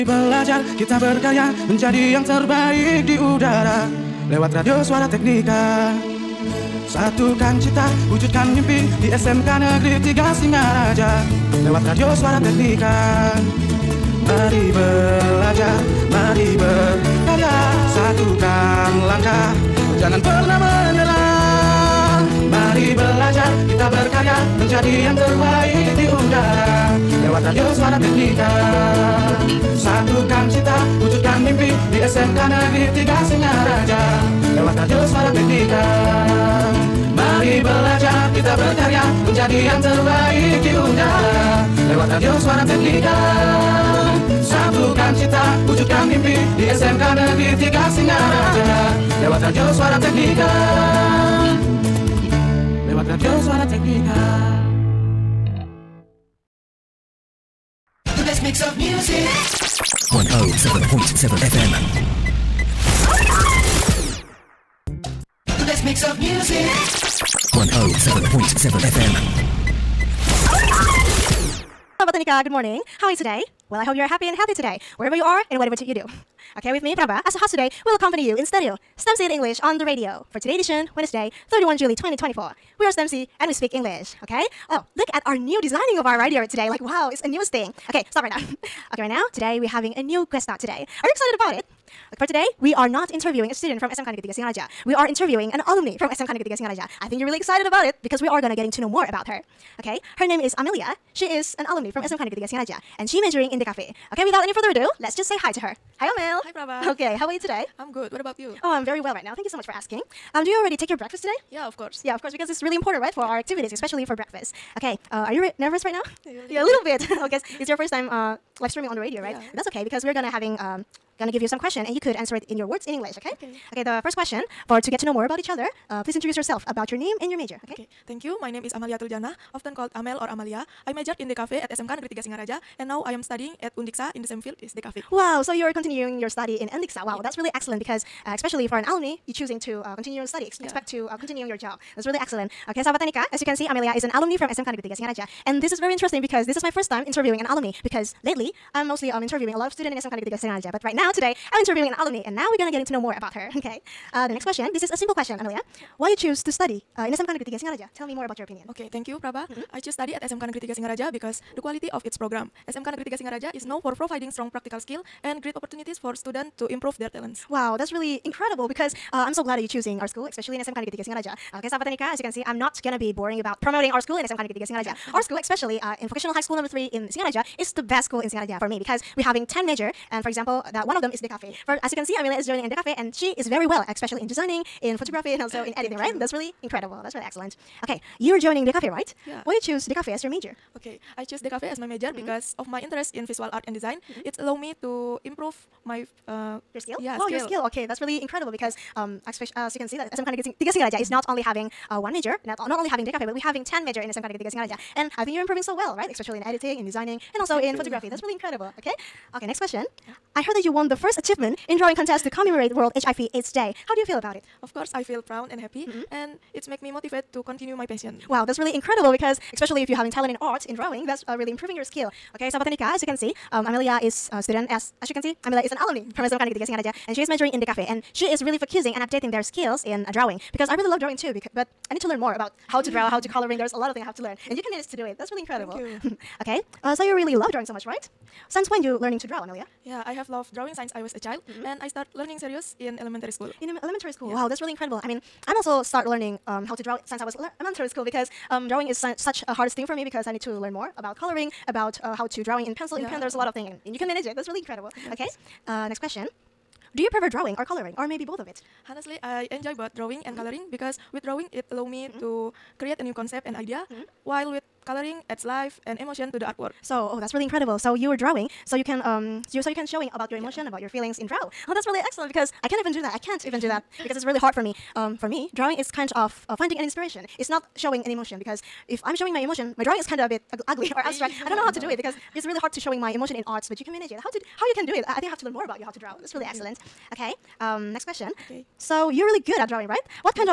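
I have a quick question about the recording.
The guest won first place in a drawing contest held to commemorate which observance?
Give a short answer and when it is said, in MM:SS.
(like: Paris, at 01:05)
World HIV/AIDS Day, at 03:32.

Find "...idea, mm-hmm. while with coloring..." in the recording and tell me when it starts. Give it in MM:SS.
04:23.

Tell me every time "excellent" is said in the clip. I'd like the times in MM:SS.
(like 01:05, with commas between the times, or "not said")
02:17, 02:22, 03:07, 04:31, 04:46.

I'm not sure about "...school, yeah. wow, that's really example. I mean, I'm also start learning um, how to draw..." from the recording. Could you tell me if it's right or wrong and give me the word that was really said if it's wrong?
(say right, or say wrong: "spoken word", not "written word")
wrong: "incredible", not "example".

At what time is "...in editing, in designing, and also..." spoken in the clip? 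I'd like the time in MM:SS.
03:26.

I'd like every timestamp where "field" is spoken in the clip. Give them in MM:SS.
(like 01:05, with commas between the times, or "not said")
02:14.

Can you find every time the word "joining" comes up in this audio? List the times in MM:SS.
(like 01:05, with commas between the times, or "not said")
03:02, 03:08.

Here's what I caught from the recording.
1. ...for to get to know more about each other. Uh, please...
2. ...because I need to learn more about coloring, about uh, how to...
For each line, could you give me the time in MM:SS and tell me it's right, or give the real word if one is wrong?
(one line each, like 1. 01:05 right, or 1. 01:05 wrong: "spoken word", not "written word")
1. 02:04 right
2. 04:10 right.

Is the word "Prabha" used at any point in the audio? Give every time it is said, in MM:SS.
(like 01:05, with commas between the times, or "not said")
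01:16, 01:46, 02:39.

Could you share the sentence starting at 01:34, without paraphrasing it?
We are interviewing an alumni from SMK Negeri Tiga Singaraja.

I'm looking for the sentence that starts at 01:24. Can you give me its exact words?
Oh, look at our new designing of our radio today.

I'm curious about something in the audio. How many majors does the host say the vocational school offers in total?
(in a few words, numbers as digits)
10.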